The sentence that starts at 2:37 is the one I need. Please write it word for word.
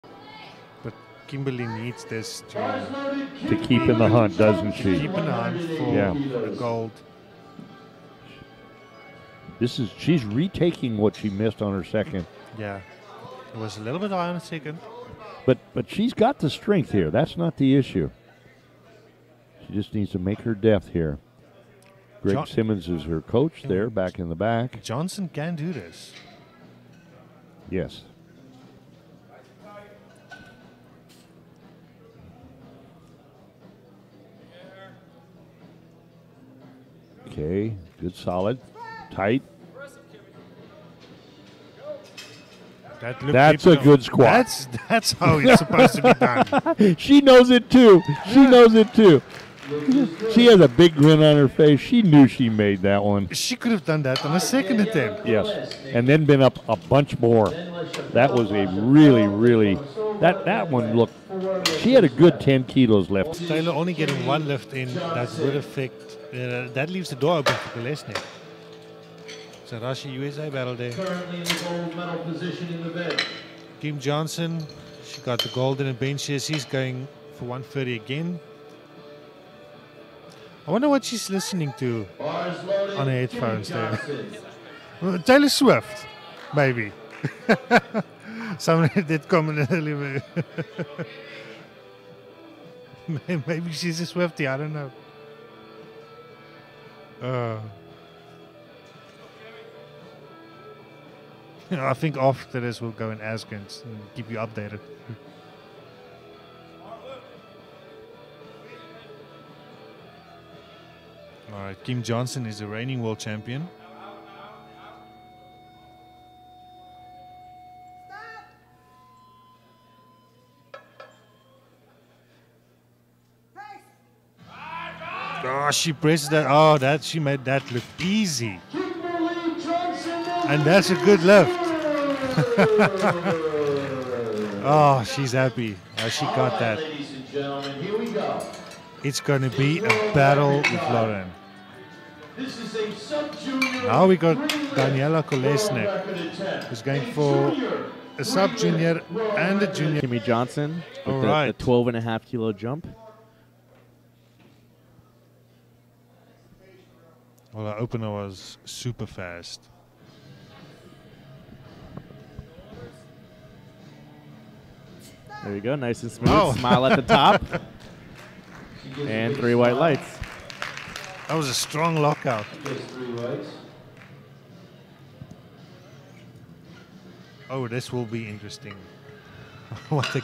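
Well, the opener was super fast.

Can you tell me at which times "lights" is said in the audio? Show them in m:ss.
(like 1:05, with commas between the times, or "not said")
2:49.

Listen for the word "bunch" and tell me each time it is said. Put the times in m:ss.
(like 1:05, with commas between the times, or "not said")
0:56.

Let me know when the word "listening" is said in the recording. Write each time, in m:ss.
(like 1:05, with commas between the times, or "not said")
1:21.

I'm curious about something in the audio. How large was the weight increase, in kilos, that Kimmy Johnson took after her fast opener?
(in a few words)
12.5 kilos.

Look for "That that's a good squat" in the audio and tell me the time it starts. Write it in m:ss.
0:43.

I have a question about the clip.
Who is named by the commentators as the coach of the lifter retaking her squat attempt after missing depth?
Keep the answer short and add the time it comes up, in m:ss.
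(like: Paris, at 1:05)
Greg John Simmons, at 0:22.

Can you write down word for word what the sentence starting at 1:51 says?
All right, Kim Johnson is the reigning world champion.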